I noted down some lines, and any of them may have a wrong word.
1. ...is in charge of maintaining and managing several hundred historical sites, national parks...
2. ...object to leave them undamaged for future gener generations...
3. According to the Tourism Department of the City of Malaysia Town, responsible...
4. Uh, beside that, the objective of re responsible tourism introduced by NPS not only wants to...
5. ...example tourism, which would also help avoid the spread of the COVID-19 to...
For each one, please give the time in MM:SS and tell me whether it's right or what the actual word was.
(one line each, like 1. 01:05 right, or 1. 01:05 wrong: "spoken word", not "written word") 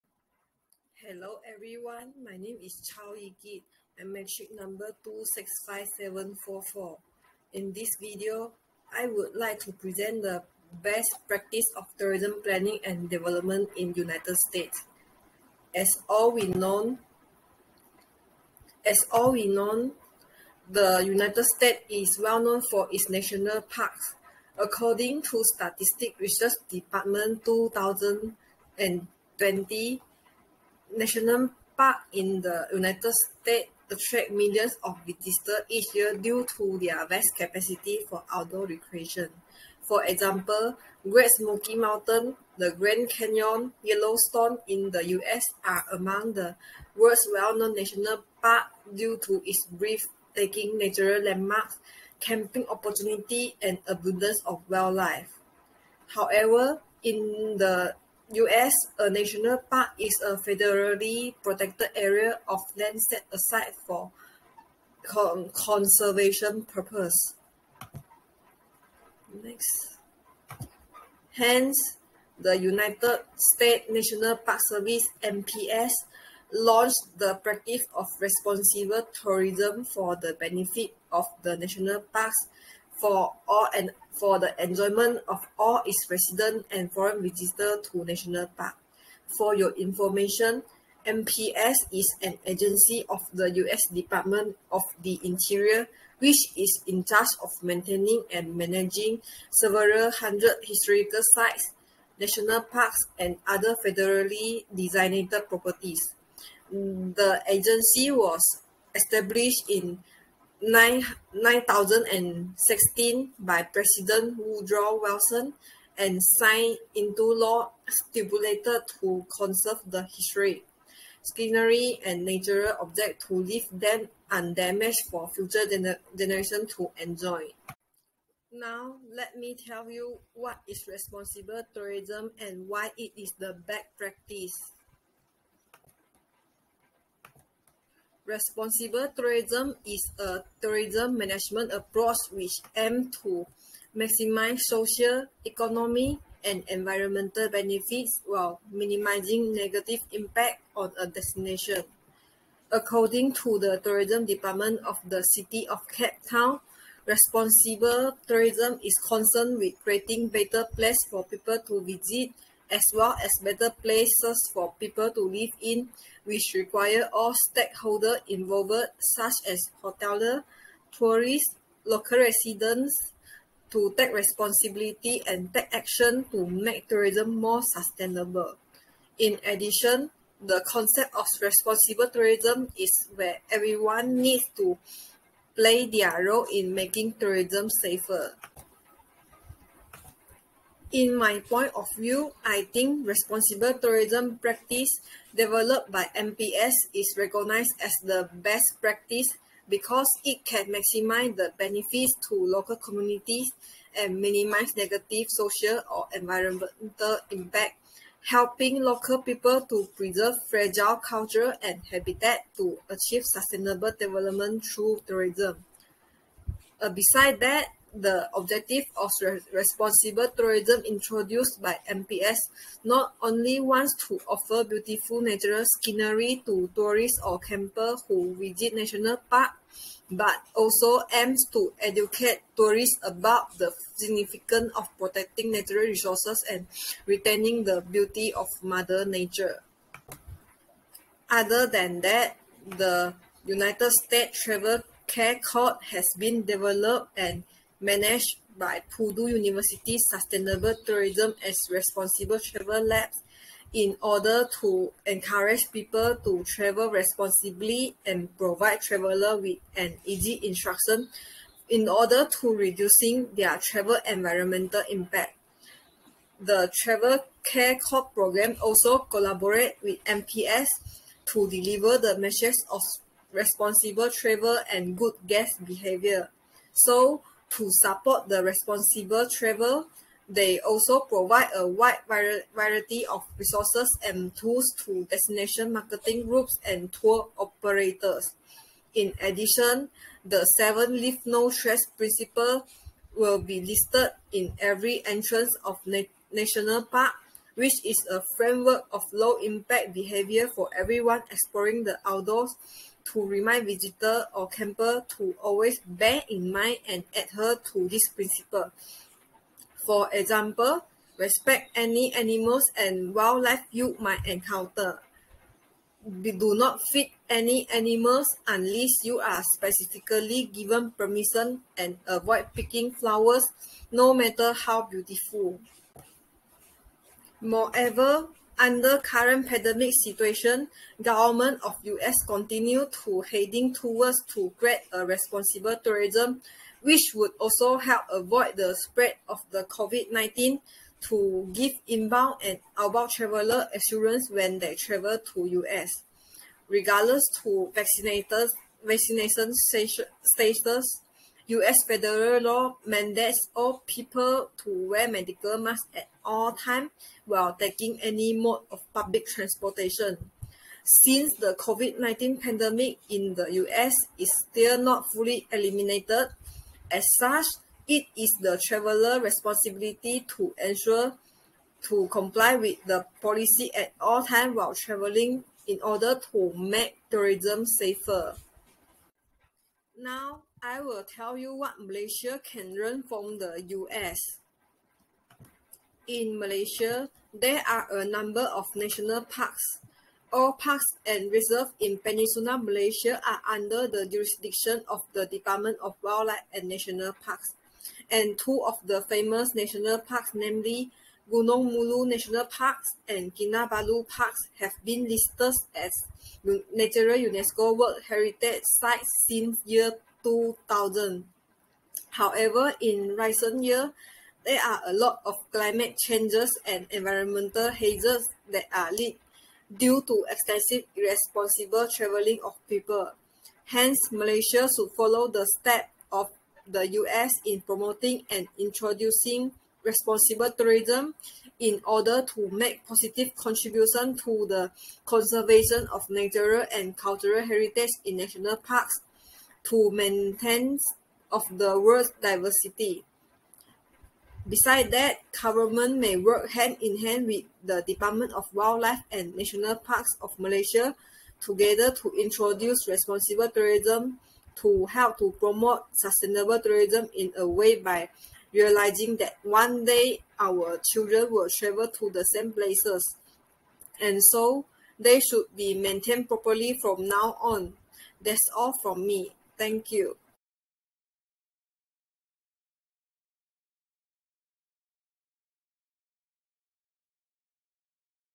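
1. 01:36 right
2. 02:02 right
3. 02:32 wrong: "Cape", not "Malaysia"
4. 03:36 right
5. 05:35 wrong: "responsible", not "example".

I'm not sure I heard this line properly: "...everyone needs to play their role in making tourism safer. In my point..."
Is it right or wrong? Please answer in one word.
right.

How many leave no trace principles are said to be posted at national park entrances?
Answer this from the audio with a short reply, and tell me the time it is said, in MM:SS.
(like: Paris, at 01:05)
7, at 04:50.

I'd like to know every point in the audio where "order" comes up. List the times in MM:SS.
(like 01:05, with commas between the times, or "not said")
04:14, 04:21, 06:15, 07:11.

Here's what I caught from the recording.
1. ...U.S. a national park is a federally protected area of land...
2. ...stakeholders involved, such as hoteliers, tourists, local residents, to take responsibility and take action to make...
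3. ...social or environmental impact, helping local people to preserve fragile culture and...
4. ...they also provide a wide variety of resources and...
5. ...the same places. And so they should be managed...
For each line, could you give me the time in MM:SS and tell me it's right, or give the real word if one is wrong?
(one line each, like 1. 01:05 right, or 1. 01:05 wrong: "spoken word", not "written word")
1. 00:58 right
2. 02:47 right
3. 03:25 right
4. 04:40 right
5. 07:42 wrong: "maintained", not "managed".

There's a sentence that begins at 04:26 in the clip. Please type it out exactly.
The Travel Care Code program also collaborate with NPS to deliver the message of responsible travel and good guest behavior.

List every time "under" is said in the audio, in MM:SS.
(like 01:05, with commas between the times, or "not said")
05:28, 06:33.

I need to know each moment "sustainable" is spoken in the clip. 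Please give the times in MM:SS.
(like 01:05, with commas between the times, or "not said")
02:57, 03:33, 04:09, 07:35.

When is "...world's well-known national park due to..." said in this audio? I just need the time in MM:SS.
00:46.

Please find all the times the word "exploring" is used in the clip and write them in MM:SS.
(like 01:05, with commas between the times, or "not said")
05:01.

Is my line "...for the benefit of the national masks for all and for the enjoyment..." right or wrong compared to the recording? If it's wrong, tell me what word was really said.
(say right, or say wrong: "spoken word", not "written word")
wrong: "parks", not "masks".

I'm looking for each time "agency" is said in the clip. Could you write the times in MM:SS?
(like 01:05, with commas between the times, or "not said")
01:32, 01:47.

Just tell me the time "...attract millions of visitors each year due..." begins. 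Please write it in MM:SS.
00:33.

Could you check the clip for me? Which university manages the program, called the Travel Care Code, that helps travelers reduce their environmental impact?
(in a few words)
Purdue University.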